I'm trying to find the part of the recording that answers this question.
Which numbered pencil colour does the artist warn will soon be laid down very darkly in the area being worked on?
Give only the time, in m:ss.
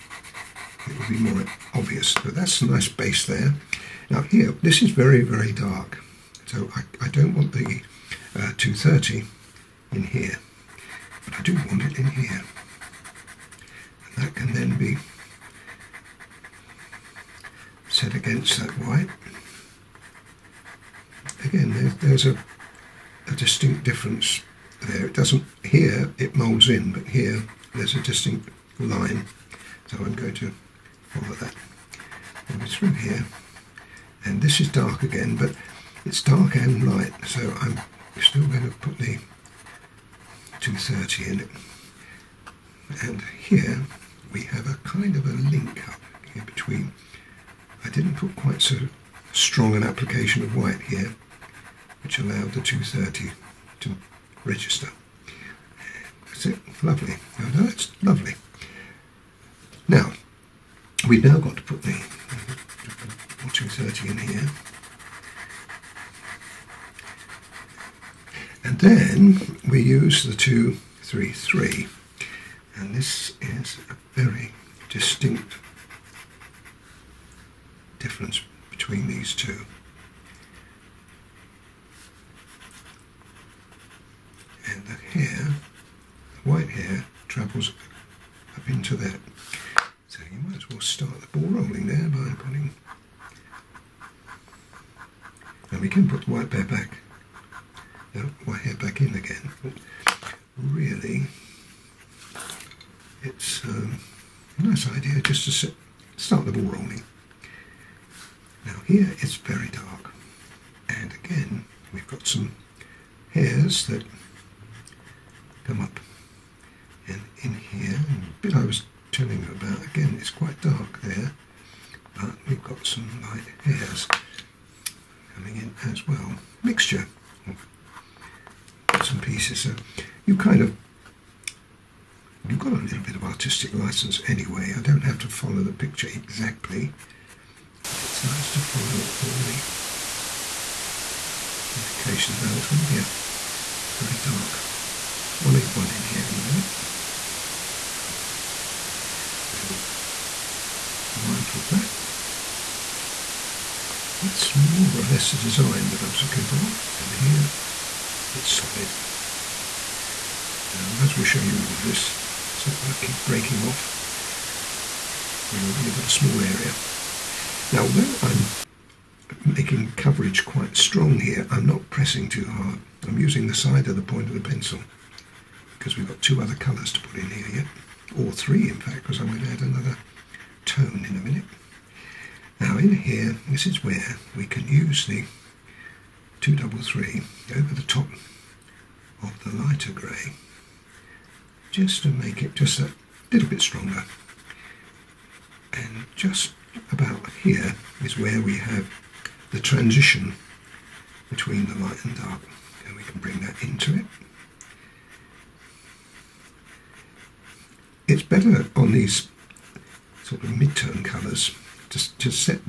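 2:25.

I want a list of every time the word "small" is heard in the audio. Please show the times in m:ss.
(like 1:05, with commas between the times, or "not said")
2:46.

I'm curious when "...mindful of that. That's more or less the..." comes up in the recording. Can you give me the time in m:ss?
2:31.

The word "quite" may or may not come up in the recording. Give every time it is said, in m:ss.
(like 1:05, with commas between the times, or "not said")
0:48, 2:00, 2:50.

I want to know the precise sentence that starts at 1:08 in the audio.
And then we use the 233 this is a very distinct difference between these two.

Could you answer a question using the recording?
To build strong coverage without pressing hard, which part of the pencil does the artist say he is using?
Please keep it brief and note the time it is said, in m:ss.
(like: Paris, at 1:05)
side of the point, at 2:53.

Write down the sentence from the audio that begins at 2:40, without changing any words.
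I might as well show you all of this.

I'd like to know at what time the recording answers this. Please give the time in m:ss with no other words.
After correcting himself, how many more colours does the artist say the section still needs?
2:58.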